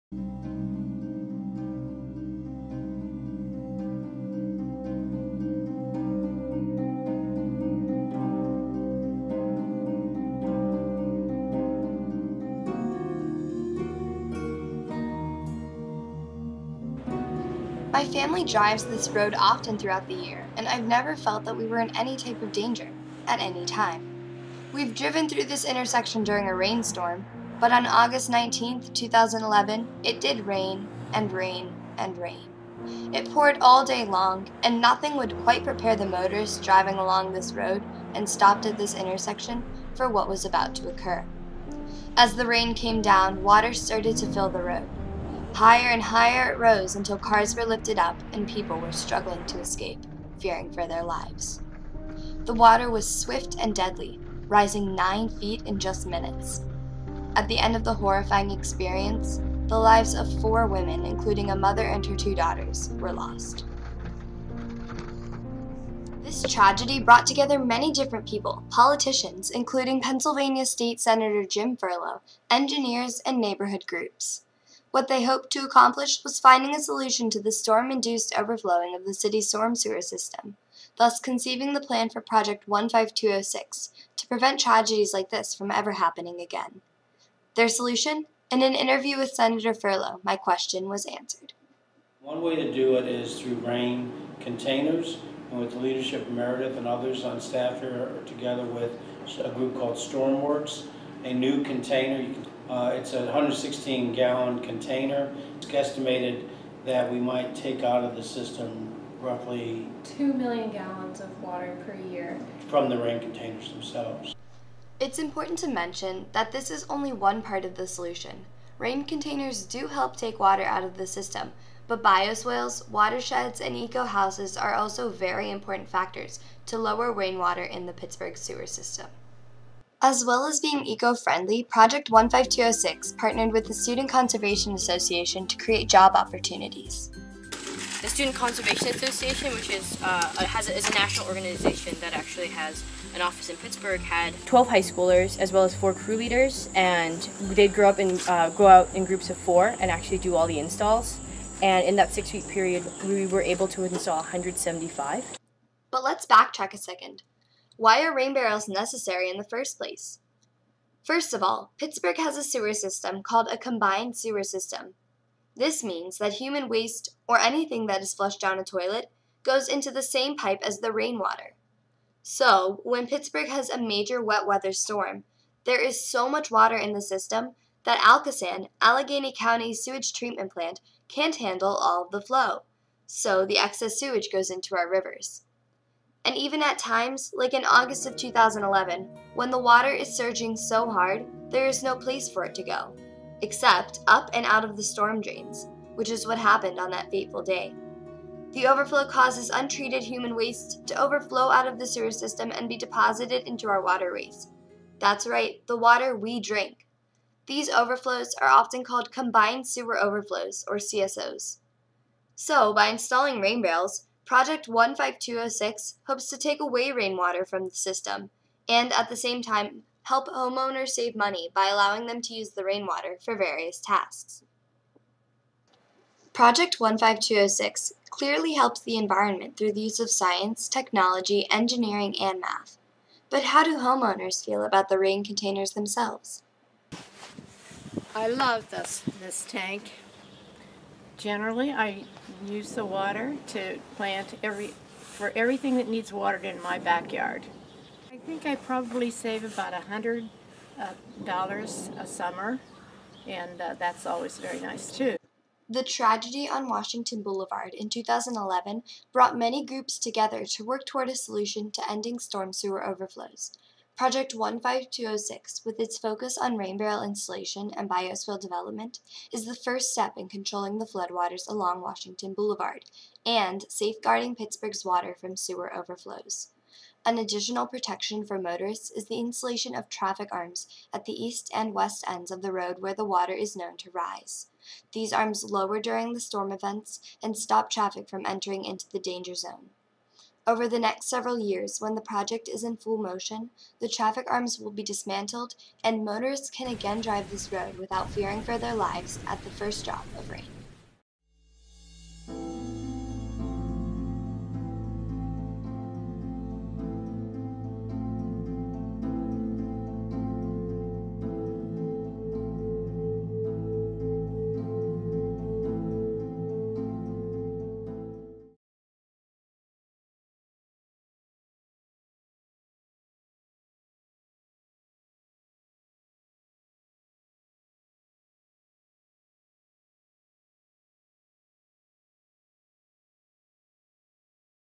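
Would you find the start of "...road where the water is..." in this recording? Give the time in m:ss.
4:42.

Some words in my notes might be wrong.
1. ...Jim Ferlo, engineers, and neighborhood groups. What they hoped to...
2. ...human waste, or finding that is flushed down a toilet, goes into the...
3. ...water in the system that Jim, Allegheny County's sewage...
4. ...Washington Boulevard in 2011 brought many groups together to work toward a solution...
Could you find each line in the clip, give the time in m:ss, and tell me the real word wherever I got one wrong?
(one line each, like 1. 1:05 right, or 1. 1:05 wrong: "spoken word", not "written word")
1. 1:11 right
2. 2:46 wrong: "anything", not "finding"
3. 2:56 wrong: "Alcosan", not "Jim"
4. 4:16 right.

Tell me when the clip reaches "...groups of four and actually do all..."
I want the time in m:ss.
2:29.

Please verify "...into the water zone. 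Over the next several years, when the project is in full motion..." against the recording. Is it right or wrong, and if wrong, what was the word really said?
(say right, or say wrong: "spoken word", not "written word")
wrong: "danger", not "water".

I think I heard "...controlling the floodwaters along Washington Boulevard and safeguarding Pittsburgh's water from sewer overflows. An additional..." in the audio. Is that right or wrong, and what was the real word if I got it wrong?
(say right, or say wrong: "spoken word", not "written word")
right.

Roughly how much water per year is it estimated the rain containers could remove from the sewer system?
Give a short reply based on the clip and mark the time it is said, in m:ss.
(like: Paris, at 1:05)
2 million gallons, at 1:50.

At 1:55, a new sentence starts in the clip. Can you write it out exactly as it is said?
It's important to mention that this is only one part of the solution.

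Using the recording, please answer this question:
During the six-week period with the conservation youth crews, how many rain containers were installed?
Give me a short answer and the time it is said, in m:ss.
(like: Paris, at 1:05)
175, at 2:34.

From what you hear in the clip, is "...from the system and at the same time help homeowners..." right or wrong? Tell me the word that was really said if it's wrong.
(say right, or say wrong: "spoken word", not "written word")
right.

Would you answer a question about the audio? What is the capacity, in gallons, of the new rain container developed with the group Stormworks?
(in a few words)
116 gallons.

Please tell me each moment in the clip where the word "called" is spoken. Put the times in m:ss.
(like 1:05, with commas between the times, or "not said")
1:39, 2:43, 3:28.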